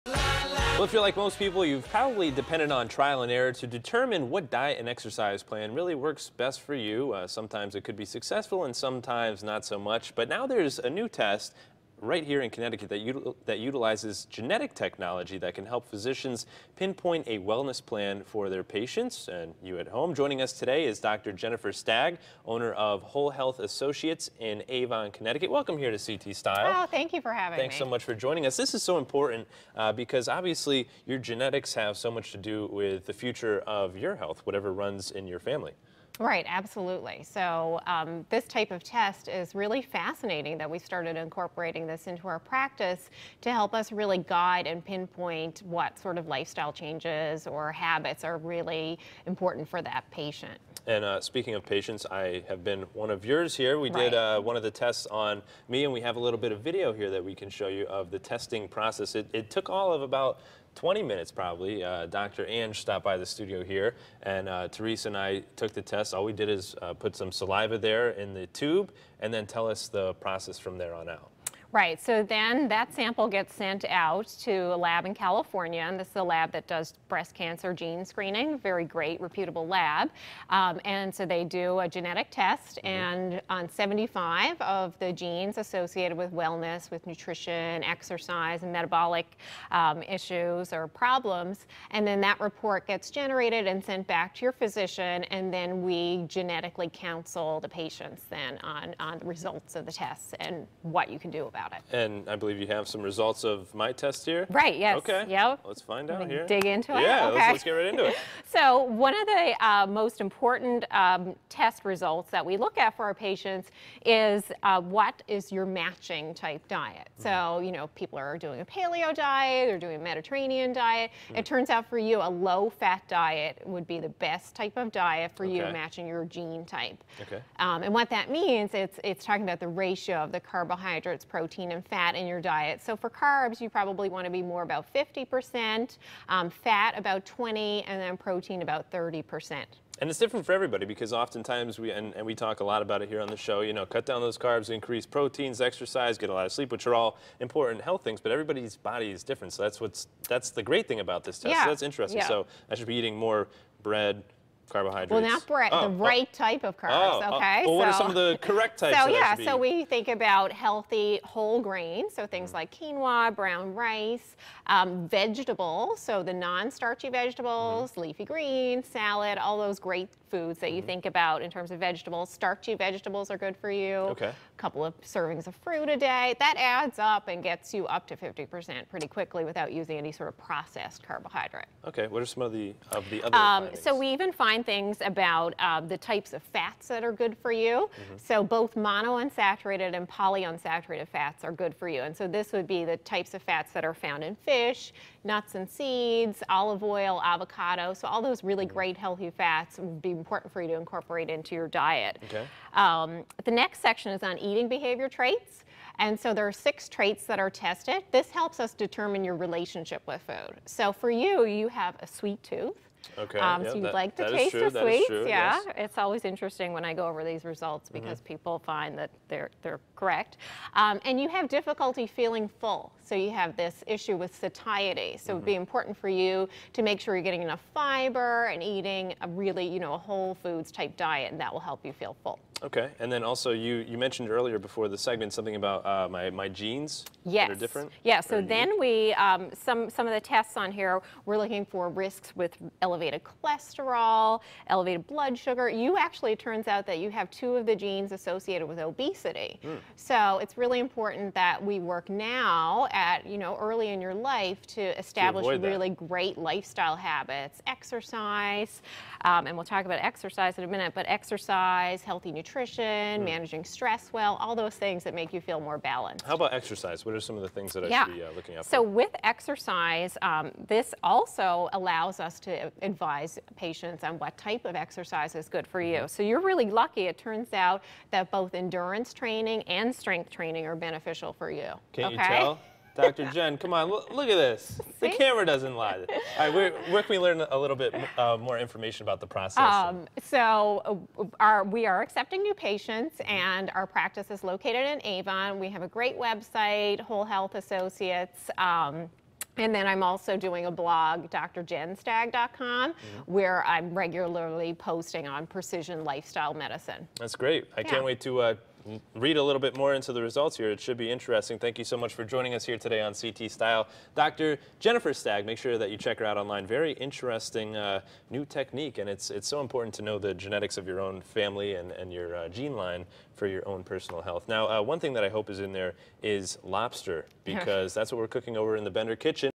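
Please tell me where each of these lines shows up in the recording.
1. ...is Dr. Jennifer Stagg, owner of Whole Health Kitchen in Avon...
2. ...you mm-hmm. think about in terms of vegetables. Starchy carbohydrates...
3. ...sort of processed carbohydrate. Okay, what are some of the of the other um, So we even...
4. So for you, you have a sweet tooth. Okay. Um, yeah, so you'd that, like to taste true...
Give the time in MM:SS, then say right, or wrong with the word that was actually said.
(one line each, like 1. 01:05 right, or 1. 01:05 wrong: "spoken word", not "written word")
1. 00:20 wrong: "Associates", not "Kitchen"
2. 02:50 wrong: "vegetables", not "carbohydrates"
3. 03:00 right
4. 03:30 right.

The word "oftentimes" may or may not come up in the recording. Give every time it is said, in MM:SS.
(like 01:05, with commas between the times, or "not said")
02:21.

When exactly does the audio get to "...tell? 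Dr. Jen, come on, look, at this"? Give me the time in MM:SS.
04:42.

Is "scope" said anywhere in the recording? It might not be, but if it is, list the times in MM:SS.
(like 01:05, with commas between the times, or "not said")
not said.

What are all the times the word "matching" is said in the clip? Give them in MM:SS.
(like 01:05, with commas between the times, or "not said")
01:55, 02:05.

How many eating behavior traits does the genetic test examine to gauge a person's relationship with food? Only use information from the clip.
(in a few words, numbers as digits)
6.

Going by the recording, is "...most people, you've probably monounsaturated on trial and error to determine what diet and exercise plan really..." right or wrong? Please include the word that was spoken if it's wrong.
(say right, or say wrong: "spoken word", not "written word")
wrong: "depended", not "monounsaturated".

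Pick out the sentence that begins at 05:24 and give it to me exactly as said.
Now, uh, one thing that I hope is in there is lobster, because that's what we're cooking over in the Bender Kitchen.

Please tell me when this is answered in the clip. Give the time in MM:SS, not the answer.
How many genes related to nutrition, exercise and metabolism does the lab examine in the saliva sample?
01:23.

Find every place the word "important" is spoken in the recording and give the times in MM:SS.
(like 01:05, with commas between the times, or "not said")
00:28, 00:49, 01:50, 02:27, 03:20, 03:45, 04:10, 05:19.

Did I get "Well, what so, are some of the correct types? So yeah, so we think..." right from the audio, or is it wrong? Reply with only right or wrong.
right.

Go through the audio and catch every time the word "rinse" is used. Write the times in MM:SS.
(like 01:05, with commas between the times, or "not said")
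not said.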